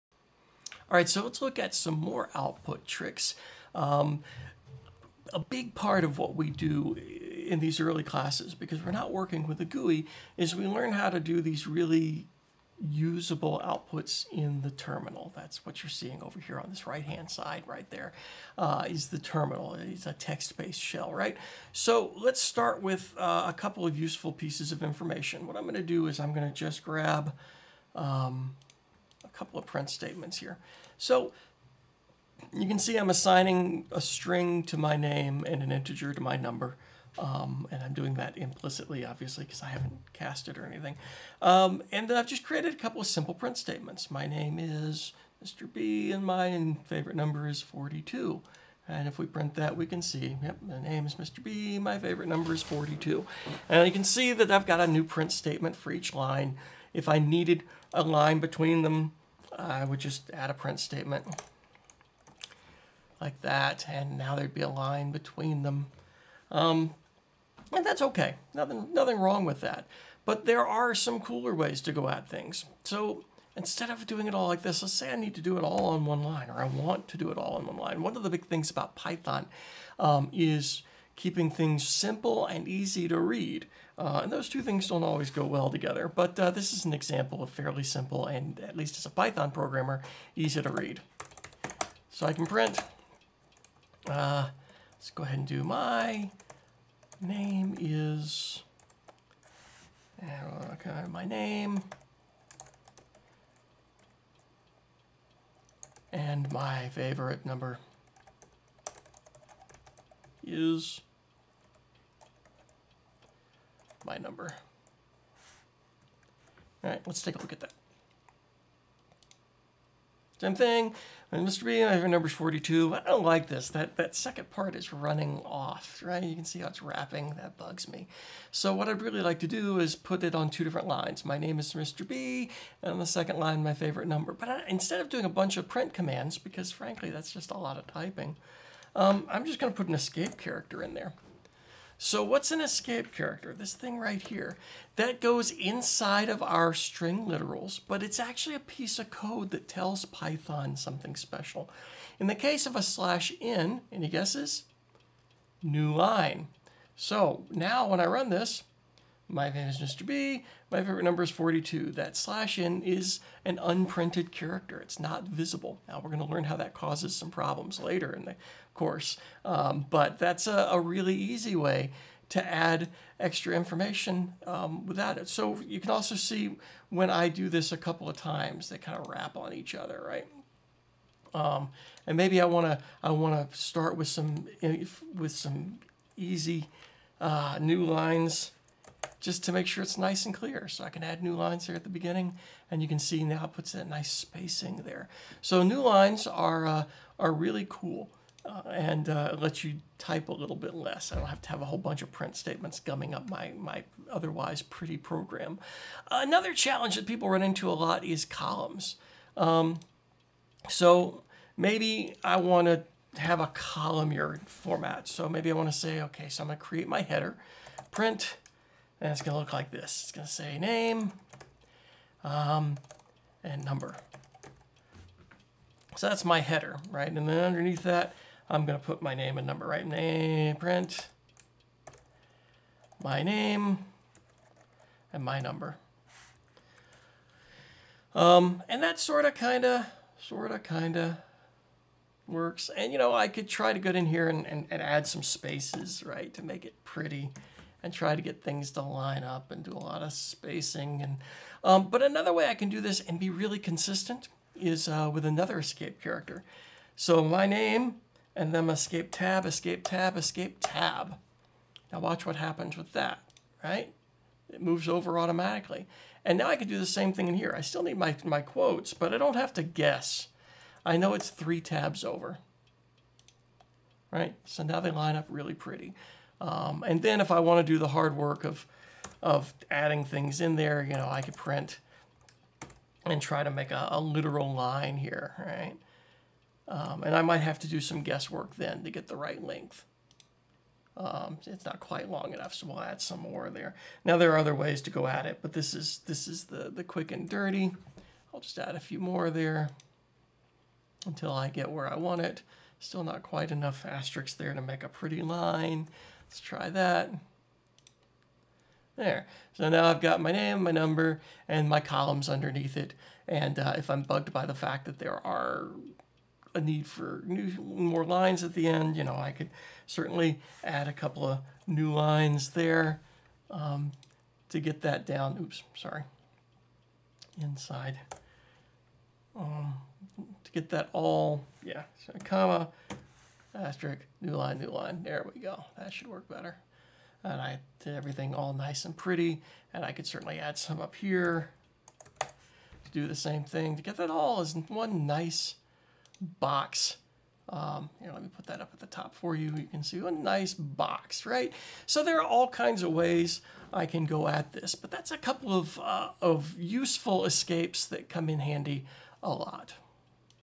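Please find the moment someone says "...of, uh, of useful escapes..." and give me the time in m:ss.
5:55.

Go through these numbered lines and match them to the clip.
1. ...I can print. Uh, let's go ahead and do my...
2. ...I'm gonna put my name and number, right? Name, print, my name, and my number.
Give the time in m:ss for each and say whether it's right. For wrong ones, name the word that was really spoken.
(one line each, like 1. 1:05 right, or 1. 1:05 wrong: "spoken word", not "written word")
1. 1:32 right
2. 3:48 right.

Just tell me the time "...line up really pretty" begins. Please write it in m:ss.
4:34.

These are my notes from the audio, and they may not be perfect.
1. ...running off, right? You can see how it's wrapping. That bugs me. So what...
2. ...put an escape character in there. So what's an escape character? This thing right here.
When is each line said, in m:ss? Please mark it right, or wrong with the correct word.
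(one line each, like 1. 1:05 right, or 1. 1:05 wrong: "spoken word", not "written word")
1. 2:04 right
2. 2:19 right.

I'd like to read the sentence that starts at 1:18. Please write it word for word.
One of the big things about Python um, is keeping things simple and easy to read.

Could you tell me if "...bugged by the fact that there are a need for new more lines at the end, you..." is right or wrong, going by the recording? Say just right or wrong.
right.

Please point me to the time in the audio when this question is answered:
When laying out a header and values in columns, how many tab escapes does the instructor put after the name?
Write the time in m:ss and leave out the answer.
4:31.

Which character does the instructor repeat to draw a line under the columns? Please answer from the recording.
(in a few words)
asterisk.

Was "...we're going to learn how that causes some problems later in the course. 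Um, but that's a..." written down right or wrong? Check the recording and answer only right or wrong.
right.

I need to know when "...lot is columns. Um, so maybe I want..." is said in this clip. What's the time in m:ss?
3:27.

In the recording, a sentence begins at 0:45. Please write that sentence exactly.
B, and my favorite number is 42.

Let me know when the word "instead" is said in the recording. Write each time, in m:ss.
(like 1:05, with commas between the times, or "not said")
1:13, 2:14.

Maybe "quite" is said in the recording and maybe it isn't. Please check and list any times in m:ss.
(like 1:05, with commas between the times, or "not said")
4:51, 5:03.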